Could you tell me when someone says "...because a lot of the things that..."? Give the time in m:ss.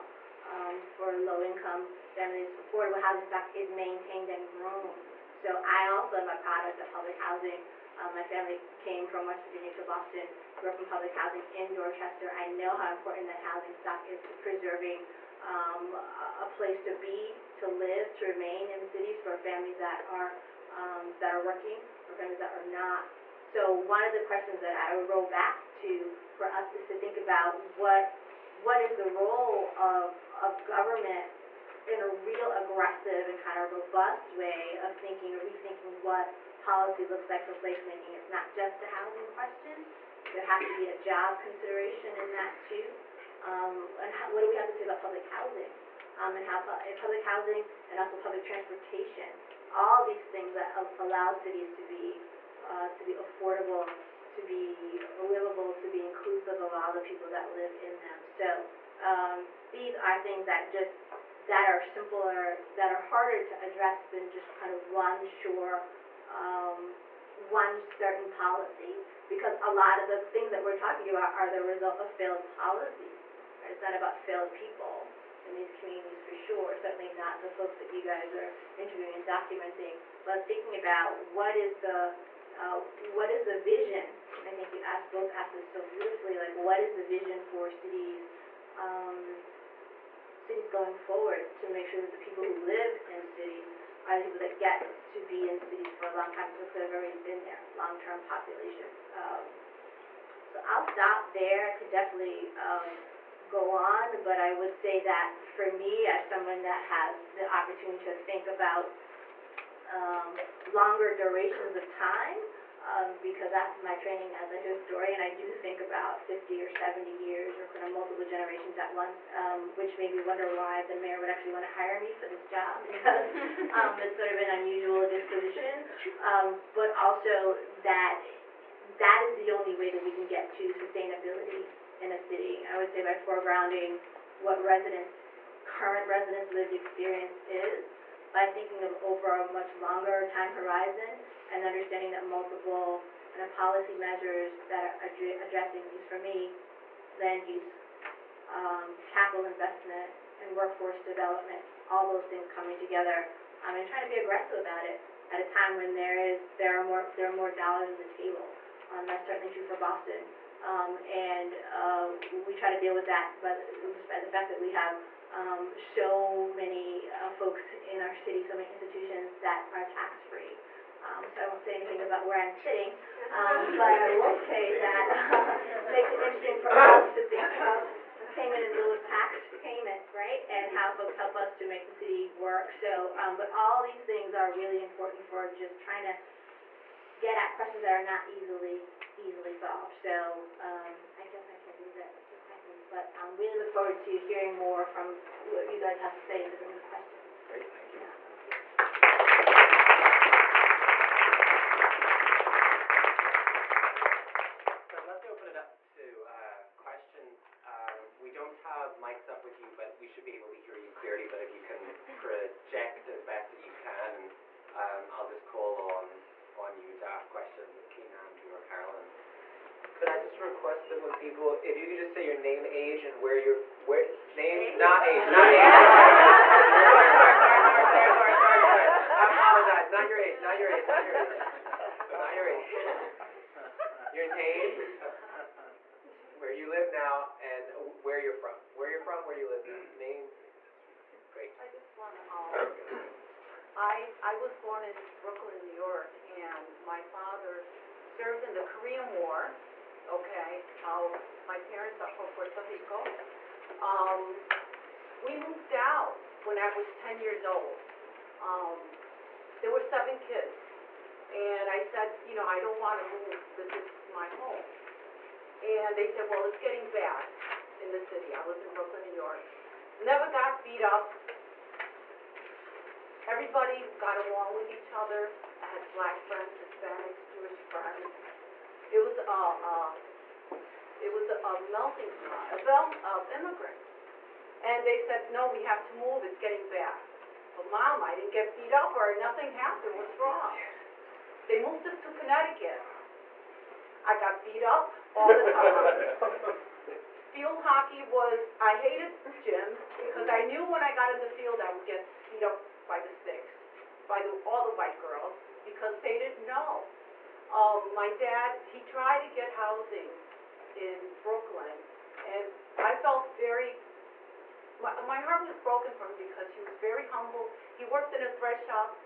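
1:09.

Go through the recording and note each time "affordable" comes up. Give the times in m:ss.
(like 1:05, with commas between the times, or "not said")
0:02, 0:53.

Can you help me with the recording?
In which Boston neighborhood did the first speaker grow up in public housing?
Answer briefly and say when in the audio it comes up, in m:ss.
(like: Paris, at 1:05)
Dorchester, at 0:11.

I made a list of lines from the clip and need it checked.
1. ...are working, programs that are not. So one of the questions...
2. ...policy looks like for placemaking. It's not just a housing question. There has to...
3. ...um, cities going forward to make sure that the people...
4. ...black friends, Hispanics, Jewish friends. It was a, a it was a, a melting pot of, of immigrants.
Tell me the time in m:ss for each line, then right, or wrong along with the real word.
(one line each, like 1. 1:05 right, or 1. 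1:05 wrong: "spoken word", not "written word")
1. 0:21 right
2. 0:36 right
3. 1:28 right
4. 4:35 right.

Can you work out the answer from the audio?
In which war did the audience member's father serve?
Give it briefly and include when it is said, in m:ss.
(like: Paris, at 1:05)
Korean War, at 4:08.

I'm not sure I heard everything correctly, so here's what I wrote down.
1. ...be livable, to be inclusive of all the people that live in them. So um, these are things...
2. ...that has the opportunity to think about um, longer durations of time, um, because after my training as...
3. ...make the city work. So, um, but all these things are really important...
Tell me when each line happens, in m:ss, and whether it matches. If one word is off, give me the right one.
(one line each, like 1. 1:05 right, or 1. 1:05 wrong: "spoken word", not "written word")
1. 0:54 right
2. 1:46 right
3. 3:01 right.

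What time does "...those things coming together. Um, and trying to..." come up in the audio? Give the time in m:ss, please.
2:32.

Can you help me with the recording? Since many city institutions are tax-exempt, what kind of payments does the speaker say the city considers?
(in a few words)
payment in lieu of tax.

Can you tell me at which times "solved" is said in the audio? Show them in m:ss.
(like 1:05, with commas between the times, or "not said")
3:09.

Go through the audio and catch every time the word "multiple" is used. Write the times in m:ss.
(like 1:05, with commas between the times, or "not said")
1:57, 2:22.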